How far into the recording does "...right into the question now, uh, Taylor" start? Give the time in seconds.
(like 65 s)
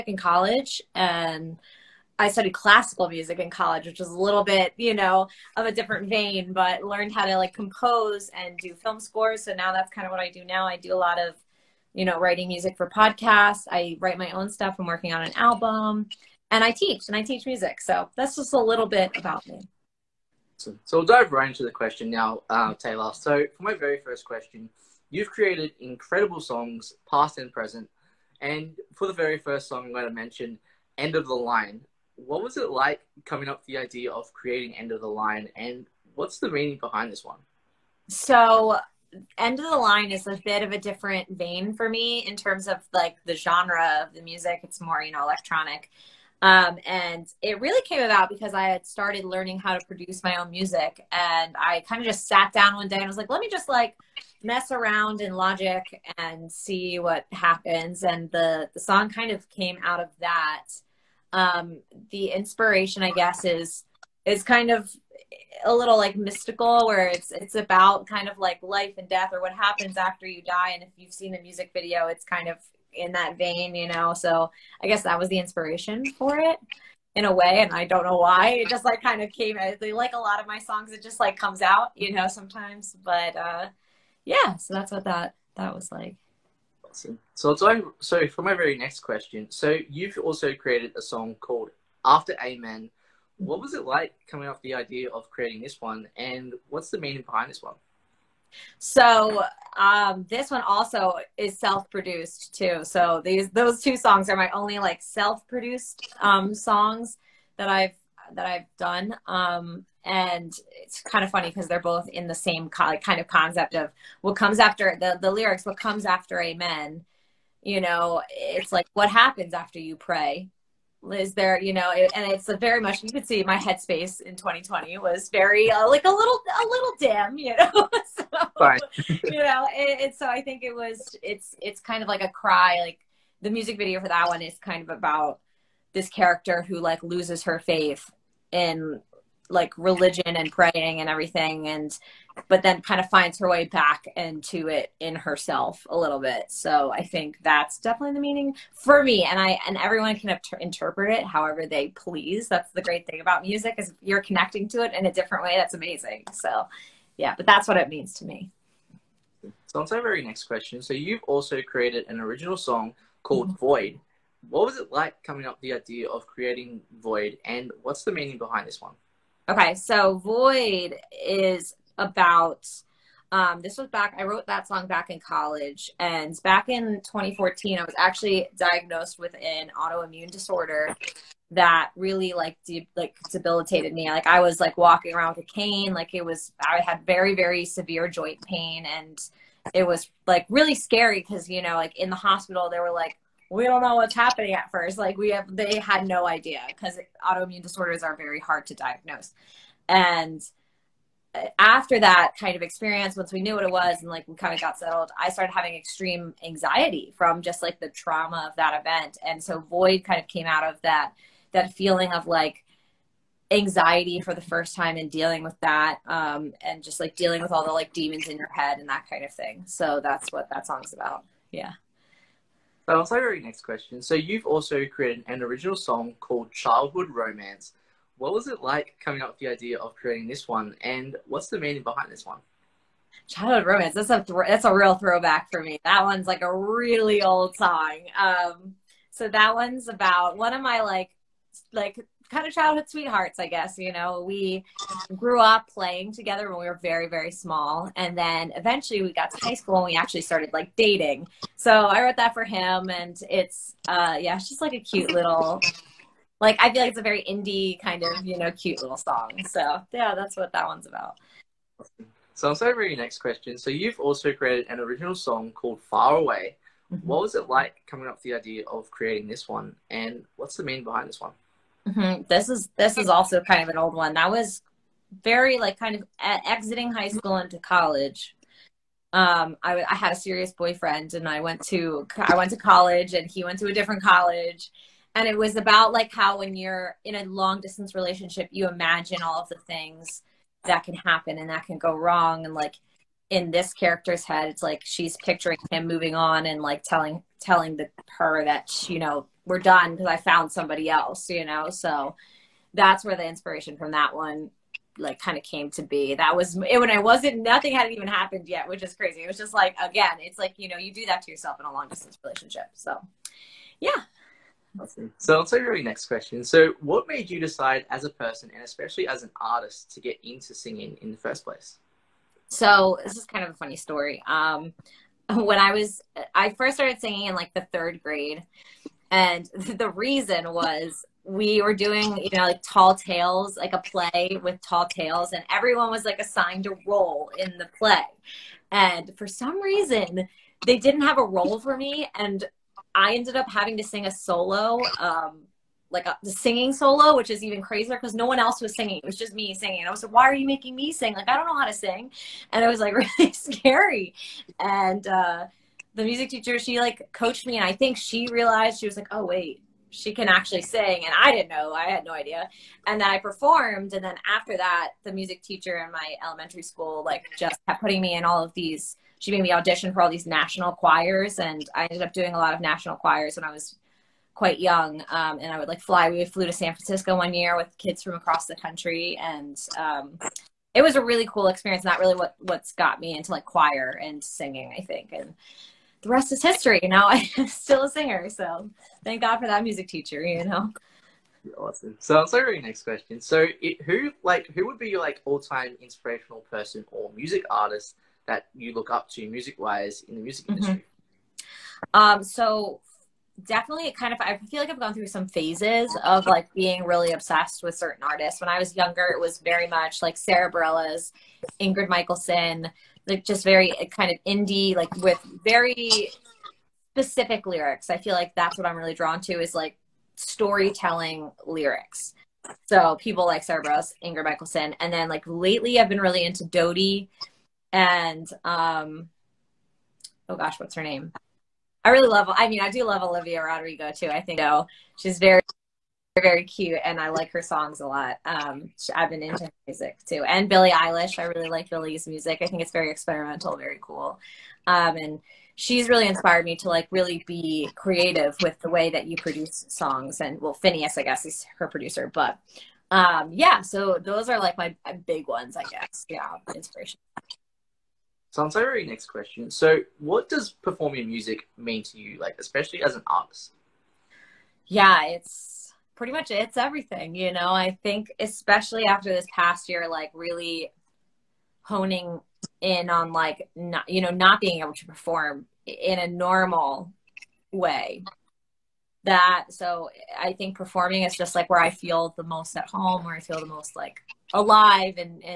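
21 s.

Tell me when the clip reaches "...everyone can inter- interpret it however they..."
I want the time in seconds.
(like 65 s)
149 s.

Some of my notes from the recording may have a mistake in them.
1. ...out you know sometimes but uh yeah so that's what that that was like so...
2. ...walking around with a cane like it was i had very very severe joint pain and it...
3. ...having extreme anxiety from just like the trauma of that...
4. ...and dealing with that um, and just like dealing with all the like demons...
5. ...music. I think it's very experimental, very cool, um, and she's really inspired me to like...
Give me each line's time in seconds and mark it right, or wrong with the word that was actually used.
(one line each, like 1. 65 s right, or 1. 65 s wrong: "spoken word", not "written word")
1. 81 s right
2. 184 s right
3. 205 s right
4. 214 s right
5. 442 s right.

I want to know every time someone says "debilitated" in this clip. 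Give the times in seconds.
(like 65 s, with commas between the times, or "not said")
183 s.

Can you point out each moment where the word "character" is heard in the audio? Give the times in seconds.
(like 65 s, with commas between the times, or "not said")
136 s, 293 s.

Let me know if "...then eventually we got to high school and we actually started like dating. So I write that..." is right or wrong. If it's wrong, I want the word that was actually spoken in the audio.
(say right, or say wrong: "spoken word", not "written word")
wrong: "wrote", not "write".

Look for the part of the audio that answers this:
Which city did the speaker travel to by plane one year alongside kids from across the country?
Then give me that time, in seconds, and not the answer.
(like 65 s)
376 s.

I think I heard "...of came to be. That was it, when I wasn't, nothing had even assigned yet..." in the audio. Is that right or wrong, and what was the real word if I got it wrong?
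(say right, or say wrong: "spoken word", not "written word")
wrong: "happened", not "assigned".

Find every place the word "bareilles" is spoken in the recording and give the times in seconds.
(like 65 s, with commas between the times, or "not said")
410 s, 423 s.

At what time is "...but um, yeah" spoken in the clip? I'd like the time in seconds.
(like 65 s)
452 s.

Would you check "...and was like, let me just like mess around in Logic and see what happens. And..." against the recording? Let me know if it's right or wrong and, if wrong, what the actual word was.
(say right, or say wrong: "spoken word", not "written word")
right.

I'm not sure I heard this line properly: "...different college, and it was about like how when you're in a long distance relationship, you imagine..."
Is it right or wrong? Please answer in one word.
right.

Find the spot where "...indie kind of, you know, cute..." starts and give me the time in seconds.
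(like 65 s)
257 s.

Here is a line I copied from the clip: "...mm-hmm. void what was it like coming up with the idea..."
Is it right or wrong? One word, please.
right.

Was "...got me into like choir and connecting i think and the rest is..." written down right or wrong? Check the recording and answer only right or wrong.
wrong.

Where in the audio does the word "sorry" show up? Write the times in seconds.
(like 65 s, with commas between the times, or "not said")
262 s, 392 s.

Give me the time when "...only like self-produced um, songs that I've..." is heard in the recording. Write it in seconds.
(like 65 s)
104 s.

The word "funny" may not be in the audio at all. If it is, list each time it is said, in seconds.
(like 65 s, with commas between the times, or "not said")
111 s, 323 s.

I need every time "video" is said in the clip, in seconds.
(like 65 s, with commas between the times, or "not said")
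71 s, 133 s.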